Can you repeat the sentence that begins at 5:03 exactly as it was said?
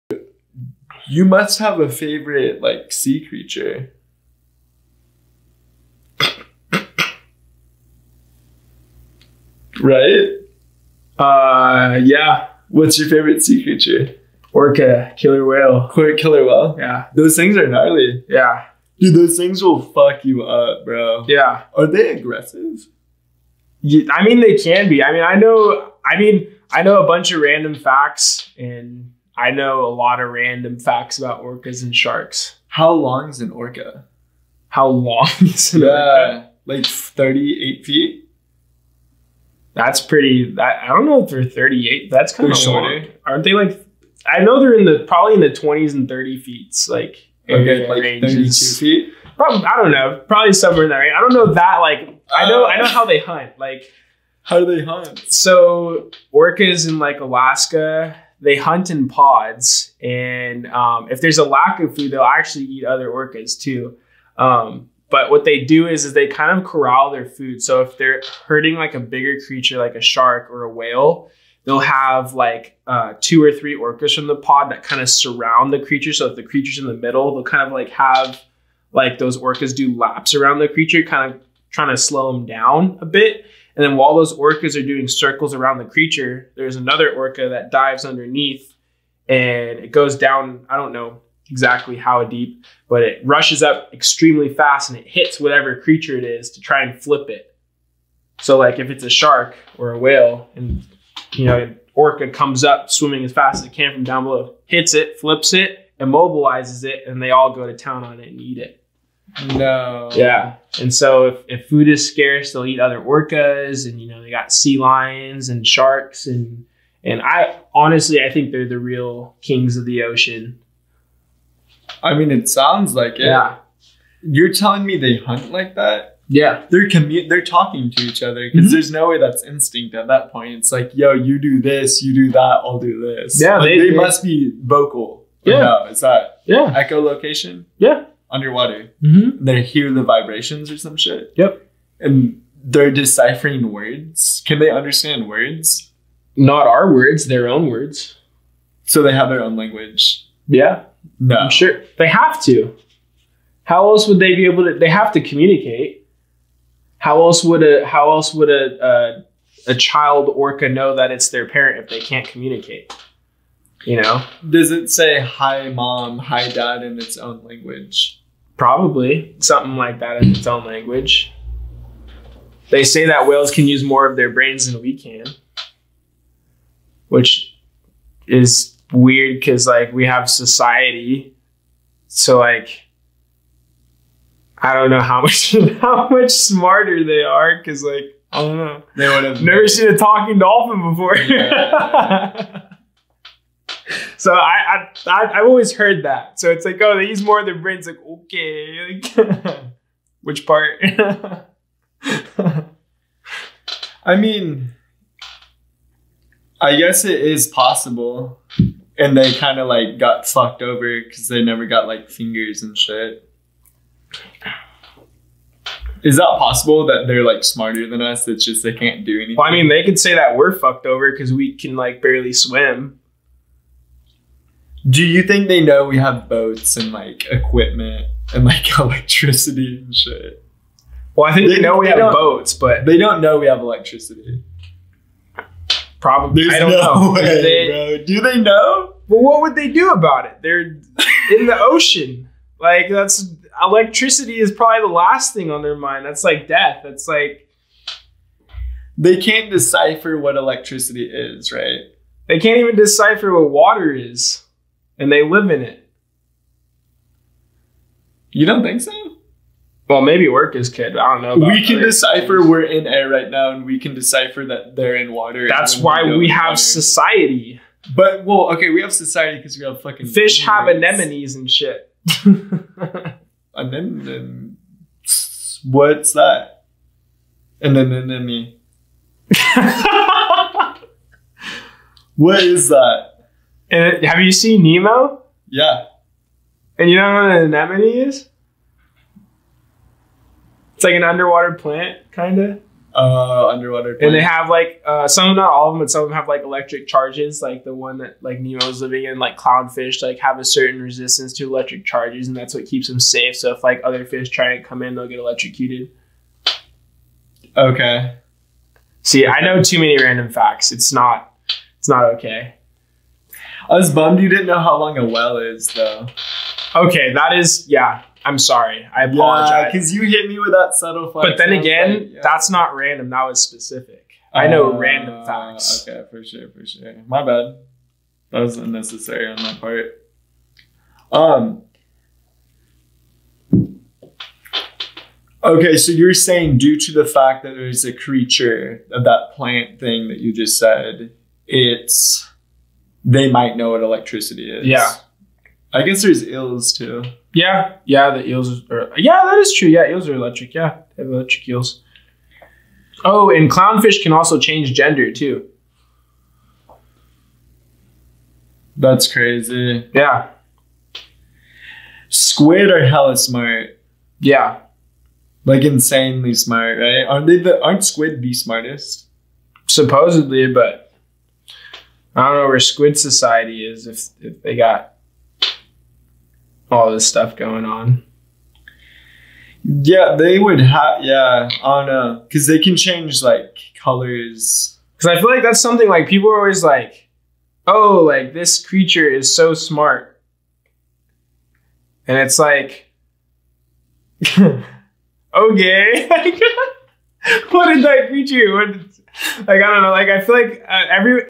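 So if like other fish try and come in, they'll get electrocuted.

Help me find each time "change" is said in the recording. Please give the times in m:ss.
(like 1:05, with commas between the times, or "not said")
5:54, 6:22.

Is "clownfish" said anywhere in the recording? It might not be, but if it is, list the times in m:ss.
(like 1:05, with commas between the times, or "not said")
4:59, 5:53.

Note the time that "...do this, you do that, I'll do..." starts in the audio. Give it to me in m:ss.
2:11.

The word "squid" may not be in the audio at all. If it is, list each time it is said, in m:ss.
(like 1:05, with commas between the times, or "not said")
6:02, 6:07, 6:12.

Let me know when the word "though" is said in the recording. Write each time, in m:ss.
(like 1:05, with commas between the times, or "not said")
5:15.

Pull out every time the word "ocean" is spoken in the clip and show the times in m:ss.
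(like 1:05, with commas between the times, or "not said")
2:00, 4:01.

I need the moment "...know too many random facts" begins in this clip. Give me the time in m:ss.
5:09.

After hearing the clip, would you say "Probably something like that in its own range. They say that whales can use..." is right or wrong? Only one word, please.
wrong.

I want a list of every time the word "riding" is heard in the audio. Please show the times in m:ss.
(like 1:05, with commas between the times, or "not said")
not said.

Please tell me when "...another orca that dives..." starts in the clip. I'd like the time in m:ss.
1:26.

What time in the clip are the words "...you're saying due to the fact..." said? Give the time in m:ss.
5:35.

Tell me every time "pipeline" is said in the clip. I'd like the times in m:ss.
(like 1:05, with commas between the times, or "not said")
not said.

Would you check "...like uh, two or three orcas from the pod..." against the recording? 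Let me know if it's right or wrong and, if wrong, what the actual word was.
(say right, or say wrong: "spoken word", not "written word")
right.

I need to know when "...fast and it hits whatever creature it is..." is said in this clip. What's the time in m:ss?
1:34.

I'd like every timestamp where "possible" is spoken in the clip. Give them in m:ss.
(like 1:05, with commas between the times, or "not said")
3:27, 3:36.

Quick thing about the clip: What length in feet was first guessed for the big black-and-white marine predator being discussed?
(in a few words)
38 feet.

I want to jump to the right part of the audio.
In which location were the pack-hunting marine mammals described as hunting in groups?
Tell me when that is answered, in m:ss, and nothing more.
0:57.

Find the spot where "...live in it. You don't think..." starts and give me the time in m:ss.
4:15.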